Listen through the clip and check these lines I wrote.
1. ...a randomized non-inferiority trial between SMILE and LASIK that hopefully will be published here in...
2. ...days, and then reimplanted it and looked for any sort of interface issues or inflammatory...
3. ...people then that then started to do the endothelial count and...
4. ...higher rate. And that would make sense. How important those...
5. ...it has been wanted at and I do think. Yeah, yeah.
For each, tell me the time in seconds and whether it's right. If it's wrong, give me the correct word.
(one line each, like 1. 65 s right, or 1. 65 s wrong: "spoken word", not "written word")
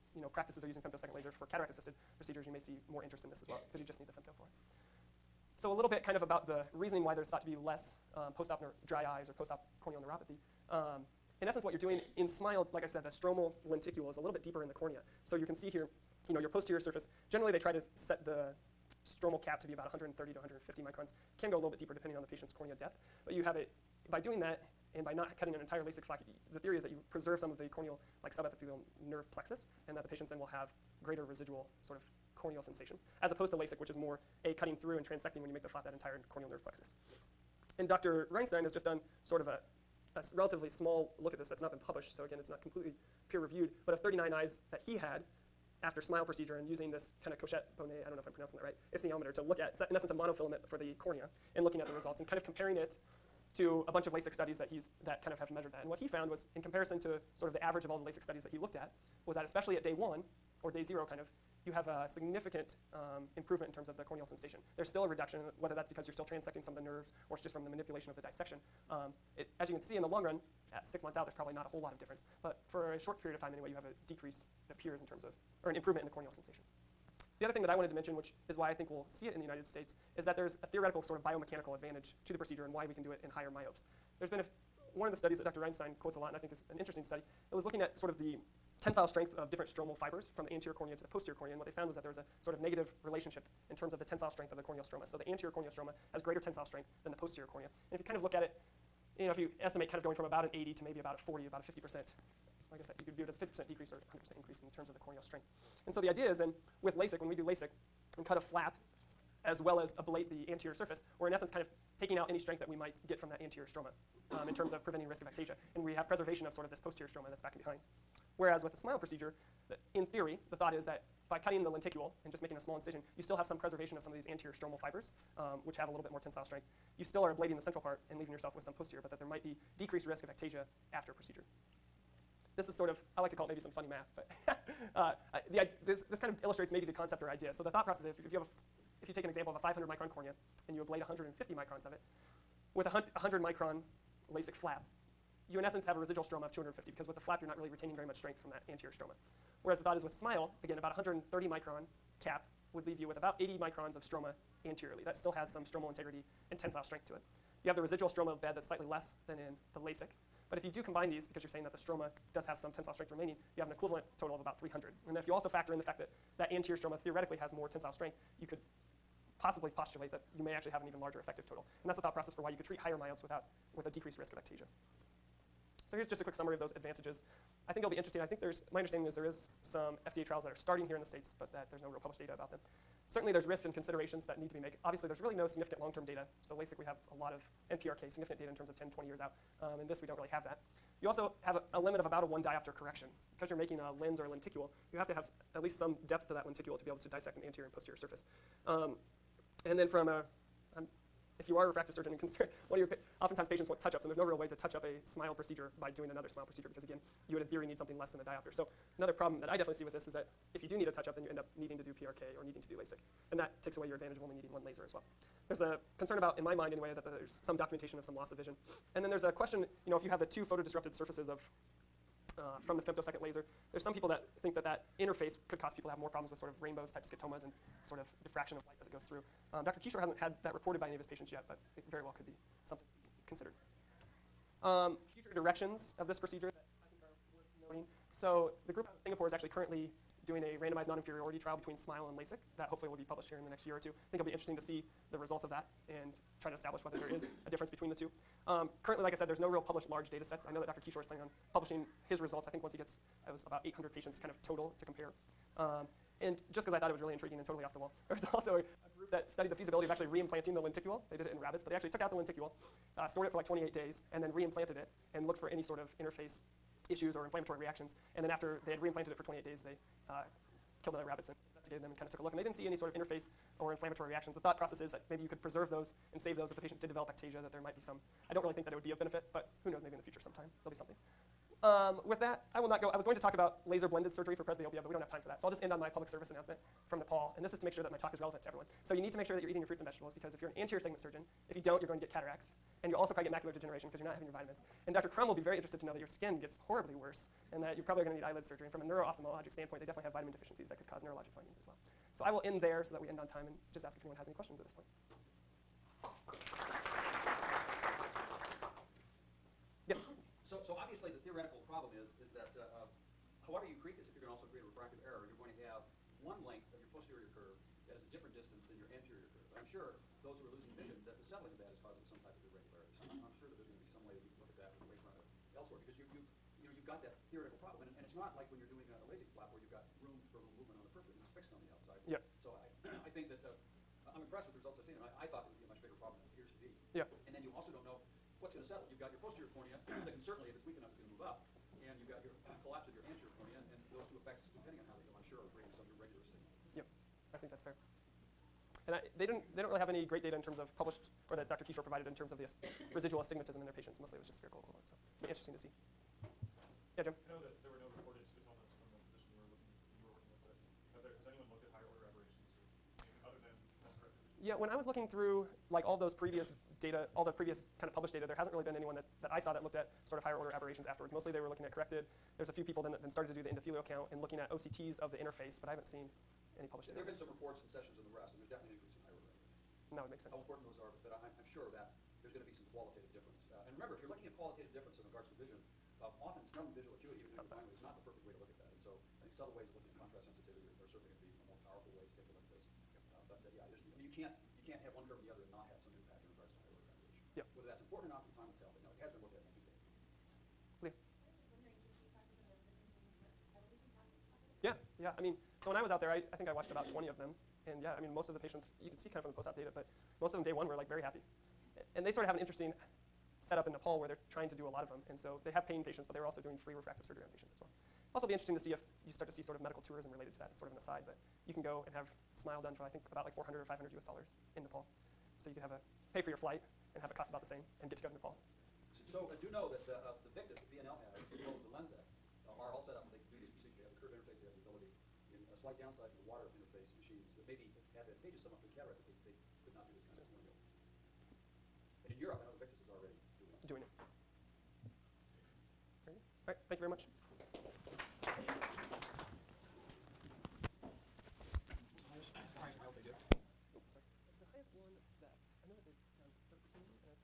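1. 240 s right
2. 263 s right
3. 372 s right
4. 379 s right
5. 398 s wrong: "looked", not "wanted".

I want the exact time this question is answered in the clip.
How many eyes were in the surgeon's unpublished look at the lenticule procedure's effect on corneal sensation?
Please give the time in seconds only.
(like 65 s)
44 s.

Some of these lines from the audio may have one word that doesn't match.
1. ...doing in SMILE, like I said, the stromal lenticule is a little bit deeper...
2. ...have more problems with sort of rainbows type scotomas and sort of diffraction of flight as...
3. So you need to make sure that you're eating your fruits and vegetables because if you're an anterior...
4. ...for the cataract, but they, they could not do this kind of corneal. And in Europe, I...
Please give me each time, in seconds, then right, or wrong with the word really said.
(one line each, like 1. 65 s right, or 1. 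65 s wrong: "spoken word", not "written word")
1. 11 s right
2. 225 s wrong: "light", not "flight"
3. 288 s right
4. 438 s right.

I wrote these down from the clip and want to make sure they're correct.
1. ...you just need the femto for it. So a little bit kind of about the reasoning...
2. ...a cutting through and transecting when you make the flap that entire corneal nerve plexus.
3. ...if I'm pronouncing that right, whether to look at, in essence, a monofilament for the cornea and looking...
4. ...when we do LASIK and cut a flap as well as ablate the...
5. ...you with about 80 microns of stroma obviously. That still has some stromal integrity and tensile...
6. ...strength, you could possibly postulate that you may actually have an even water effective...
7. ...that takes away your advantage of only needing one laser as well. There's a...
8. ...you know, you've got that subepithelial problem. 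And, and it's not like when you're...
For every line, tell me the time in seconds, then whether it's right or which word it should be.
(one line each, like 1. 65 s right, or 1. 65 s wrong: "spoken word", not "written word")
1. 3 s right
2. 34 s right
3. 48 s wrong: "esthesiometer", not "whether"
4. 107 s right
5. 152 s wrong: "anteriorly", not "obviously"
6. 167 s wrong: "larger", not "water"
7. 213 s right
8. 326 s wrong: "theoretical", not "subepithelial".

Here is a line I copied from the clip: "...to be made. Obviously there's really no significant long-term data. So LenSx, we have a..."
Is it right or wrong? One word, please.
wrong.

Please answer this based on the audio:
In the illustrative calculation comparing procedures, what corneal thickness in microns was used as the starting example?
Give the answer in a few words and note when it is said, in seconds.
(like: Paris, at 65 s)
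500 microns, at 139 s.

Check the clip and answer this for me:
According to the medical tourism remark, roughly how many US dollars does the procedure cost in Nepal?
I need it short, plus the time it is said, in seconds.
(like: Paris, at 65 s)
400 to 500, at 423 s.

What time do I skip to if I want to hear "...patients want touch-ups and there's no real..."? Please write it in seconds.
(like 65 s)
203 s.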